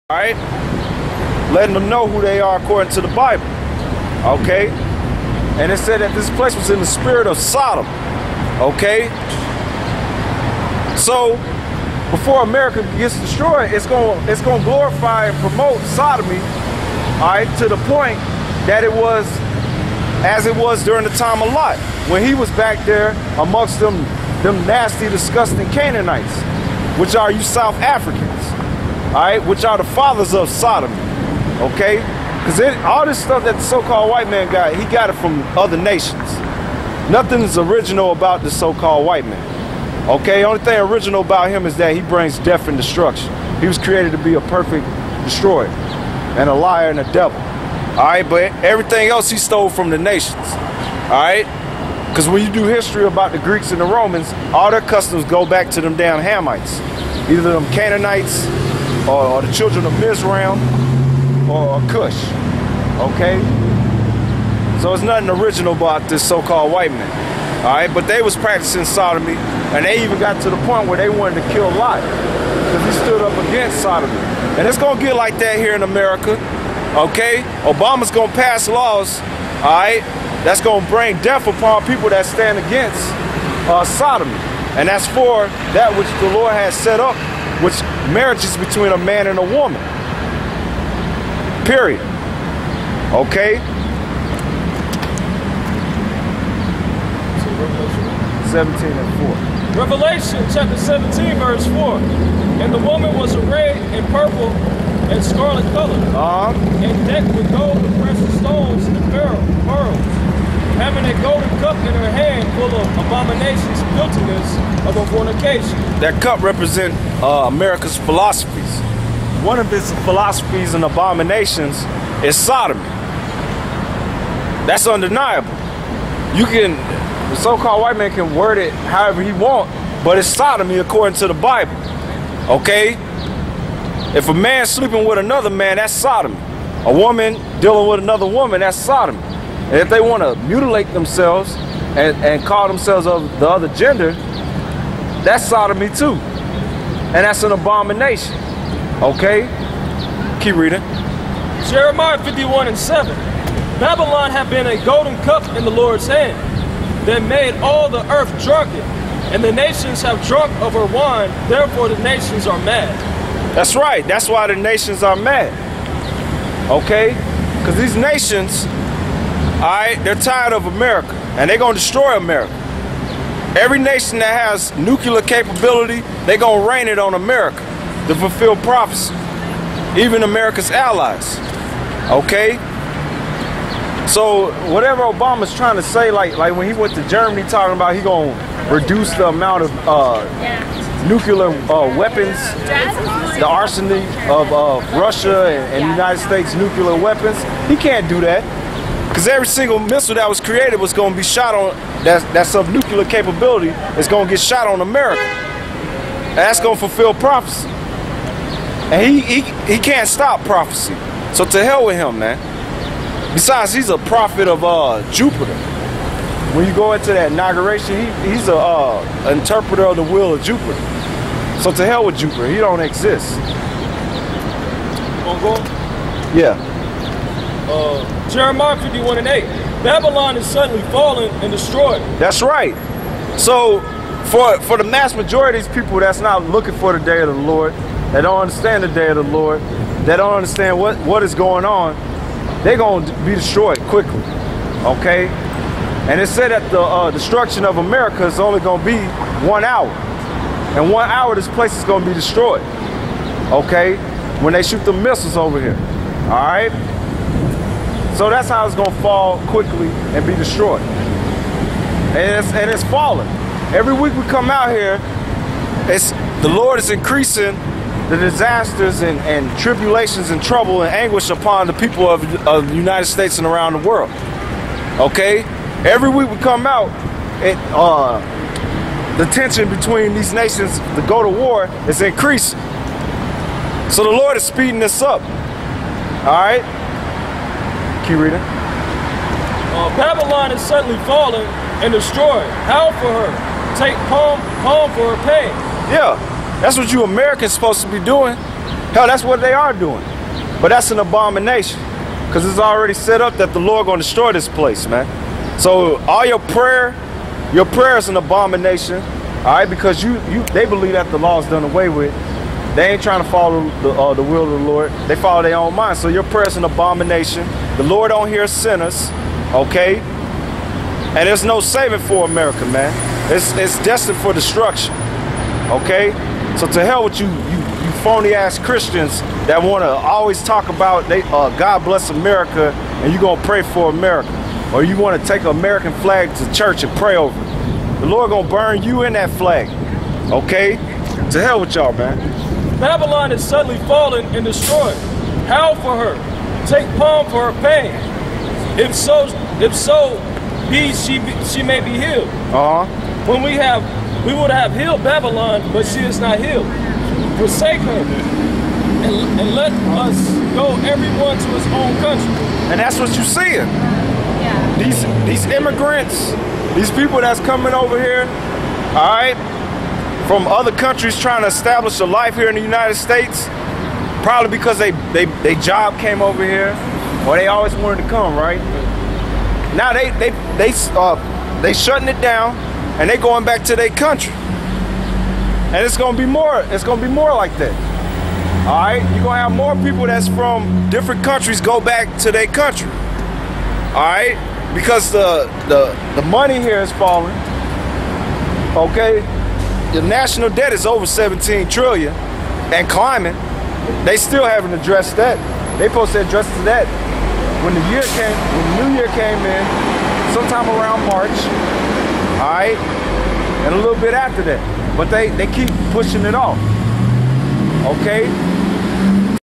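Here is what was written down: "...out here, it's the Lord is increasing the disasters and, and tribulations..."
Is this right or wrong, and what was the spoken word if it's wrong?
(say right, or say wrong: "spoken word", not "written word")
right.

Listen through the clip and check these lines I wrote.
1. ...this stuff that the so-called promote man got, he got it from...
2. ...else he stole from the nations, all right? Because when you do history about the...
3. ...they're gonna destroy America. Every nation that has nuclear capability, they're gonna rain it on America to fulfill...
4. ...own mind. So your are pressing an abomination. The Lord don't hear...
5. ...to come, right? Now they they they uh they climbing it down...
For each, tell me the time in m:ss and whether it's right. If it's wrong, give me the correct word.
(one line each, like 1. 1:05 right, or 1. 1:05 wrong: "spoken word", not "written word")
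1. 0:33 wrong: "white", not "promote"
2. 0:49 right
3. 2:51 right
4. 5:15 right
5. 6:18 wrong: "shutting", not "climbing".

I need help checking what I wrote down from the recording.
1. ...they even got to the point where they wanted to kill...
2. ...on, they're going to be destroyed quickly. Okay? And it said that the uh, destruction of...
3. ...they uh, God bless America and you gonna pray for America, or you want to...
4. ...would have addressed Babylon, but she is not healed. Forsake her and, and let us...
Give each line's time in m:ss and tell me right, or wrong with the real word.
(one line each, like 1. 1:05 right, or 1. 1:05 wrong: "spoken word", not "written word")
1. 1:09 right
2. 4:01 right
3. 5:31 right
4. 5:54 wrong: "healed", not "addressed".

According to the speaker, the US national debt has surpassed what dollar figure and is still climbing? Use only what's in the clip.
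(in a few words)
17 trillion.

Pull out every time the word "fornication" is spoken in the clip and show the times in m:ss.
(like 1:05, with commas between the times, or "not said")
1:55.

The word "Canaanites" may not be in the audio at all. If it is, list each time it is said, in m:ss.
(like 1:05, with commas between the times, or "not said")
0:25, 0:57.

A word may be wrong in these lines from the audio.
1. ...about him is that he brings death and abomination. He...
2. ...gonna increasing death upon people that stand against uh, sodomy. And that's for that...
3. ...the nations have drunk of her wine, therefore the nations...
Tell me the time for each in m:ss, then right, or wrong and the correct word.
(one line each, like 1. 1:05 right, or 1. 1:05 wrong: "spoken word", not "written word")
1. 0:41 wrong: "destruction", not "abomination"
2. 1:20 wrong: "bring", not "increasing"
3. 2:39 right.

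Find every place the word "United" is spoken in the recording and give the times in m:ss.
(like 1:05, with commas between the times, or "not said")
3:15, 4:32, 6:12.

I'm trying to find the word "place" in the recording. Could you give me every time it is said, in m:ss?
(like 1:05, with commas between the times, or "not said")
0:06, 4:11, 5:04.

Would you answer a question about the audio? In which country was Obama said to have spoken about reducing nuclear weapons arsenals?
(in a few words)
Germany.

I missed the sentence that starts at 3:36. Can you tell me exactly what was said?
When you go into that inauguration, he, he's a uh, interpreter of the will of Jupiter.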